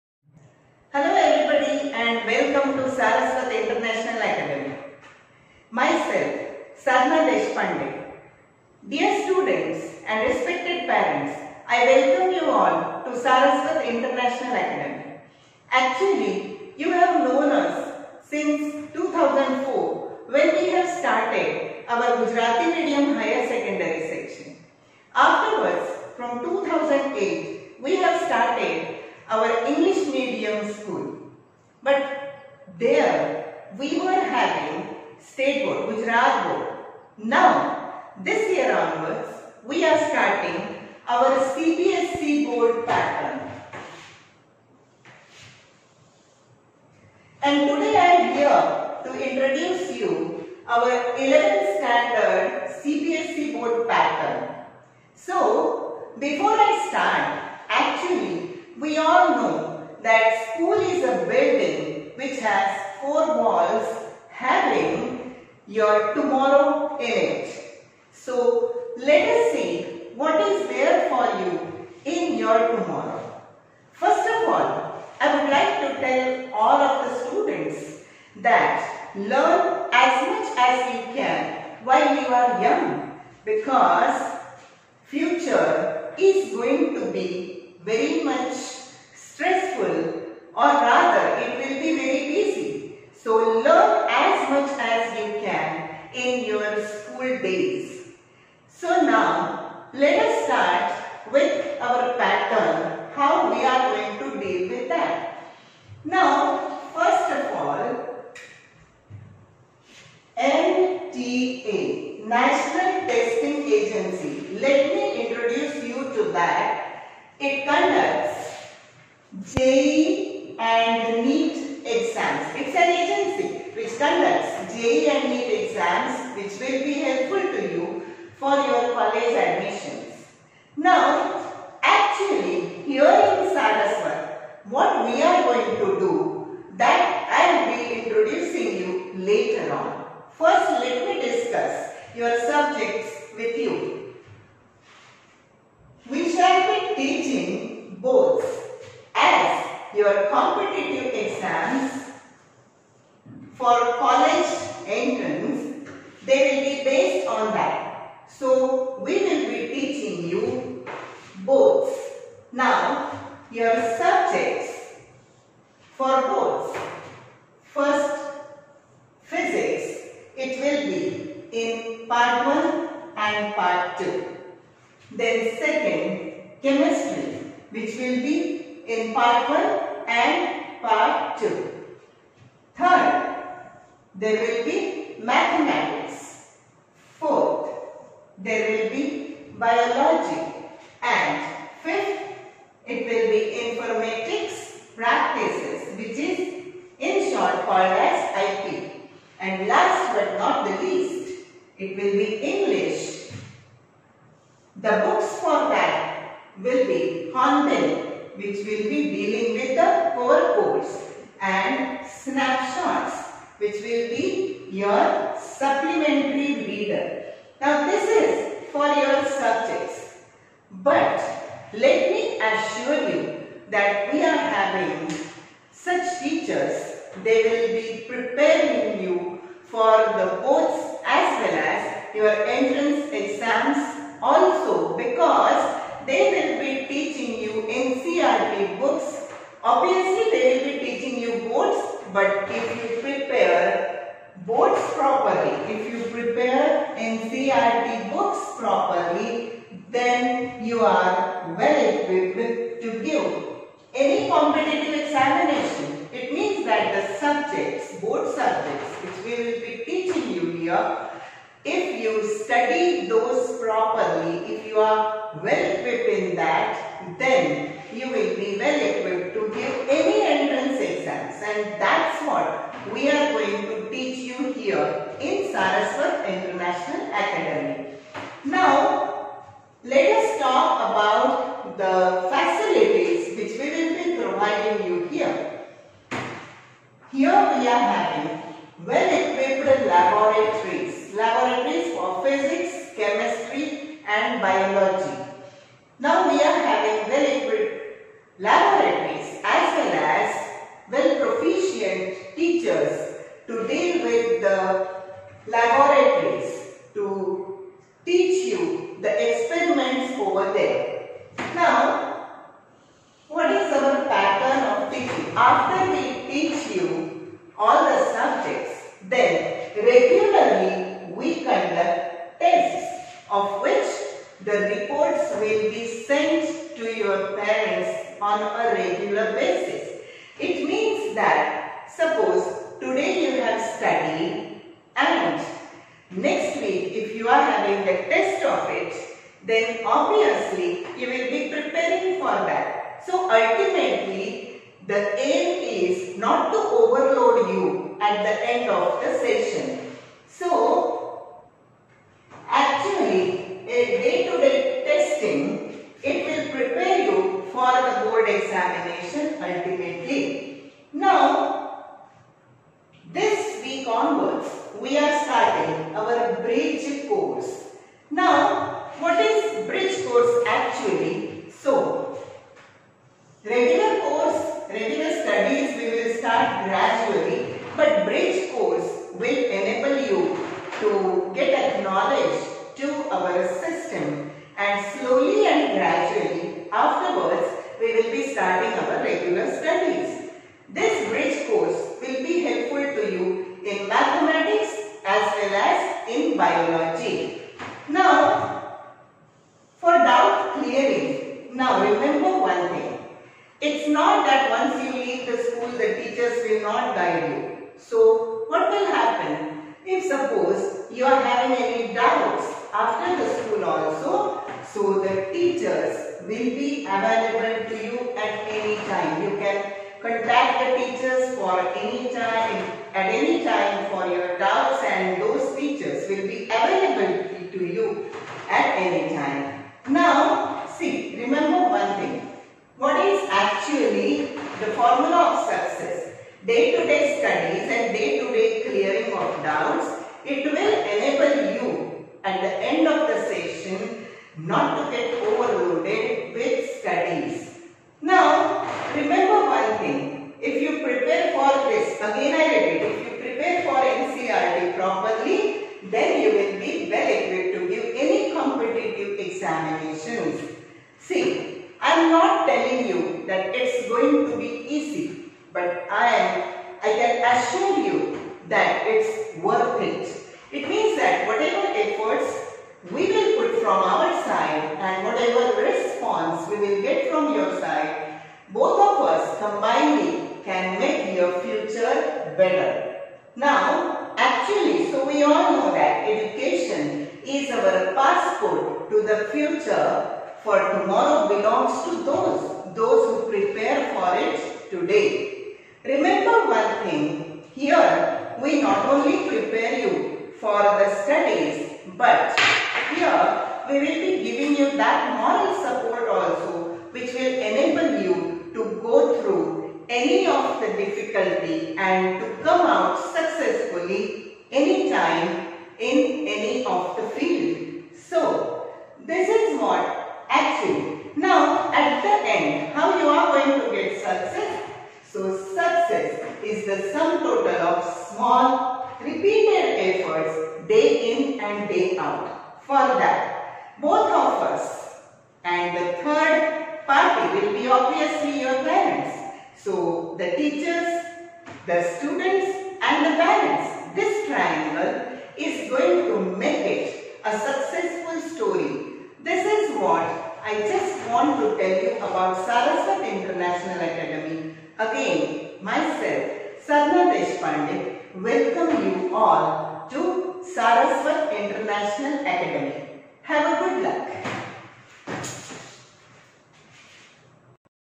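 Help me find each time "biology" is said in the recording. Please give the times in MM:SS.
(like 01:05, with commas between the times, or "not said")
03:09, 04:54, 06:36.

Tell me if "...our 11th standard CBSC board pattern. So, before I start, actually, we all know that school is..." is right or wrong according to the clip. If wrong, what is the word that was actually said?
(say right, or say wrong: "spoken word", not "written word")
right.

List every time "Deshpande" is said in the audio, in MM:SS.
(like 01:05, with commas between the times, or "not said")
00:07, 09:17.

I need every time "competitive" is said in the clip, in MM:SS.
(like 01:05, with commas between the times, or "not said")
02:30, 04:14, 07:38.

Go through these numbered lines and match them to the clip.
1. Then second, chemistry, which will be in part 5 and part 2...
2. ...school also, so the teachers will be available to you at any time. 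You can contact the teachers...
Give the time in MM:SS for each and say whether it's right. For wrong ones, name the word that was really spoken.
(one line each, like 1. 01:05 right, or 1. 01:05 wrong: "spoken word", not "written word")
1. 02:55 wrong: "1", not "5"
2. 06:53 right.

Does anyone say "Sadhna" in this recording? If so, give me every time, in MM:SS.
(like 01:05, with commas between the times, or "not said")
00:06, 09:16.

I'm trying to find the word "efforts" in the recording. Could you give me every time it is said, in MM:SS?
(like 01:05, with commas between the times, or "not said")
07:51, 08:50.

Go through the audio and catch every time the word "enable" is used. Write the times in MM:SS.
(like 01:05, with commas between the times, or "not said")
06:19, 07:20, 08:27.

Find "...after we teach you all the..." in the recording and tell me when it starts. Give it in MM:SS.
05:15.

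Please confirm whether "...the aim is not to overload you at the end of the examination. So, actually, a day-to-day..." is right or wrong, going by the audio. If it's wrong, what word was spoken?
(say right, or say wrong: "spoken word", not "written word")
wrong: "session", not "examination".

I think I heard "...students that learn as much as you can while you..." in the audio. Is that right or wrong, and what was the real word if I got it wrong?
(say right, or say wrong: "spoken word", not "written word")
right.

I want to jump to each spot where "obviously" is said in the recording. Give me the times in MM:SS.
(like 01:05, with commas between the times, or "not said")
05:39, 08:57.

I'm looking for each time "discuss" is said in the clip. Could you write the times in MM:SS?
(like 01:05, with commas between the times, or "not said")
02:21.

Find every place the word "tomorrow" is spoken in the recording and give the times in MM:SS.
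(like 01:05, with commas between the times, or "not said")
01:06, 01:12, 08:10.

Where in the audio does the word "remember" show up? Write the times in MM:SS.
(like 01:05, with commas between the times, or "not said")
07:11, 07:28, 08:15.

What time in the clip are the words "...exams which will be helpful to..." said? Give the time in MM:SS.
02:05.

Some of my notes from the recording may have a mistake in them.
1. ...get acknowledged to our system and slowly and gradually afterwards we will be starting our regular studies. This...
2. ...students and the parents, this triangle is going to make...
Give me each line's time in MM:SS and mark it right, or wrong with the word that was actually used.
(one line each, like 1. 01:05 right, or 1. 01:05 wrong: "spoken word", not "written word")
1. 06:21 right
2. 09:01 right.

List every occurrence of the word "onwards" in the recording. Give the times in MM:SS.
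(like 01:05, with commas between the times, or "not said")
00:38, 06:03.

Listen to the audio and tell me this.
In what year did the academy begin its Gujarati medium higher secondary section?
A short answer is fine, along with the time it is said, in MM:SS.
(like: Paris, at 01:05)
2004, at 00:18.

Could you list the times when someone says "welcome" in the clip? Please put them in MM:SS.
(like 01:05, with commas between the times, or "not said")
00:02, 00:11, 09:18.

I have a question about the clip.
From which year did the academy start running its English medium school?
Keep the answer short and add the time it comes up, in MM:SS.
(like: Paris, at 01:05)
2008, at 00:26.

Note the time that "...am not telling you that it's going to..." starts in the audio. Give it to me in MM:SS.
07:41.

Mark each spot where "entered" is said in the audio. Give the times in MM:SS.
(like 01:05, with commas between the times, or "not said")
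not said.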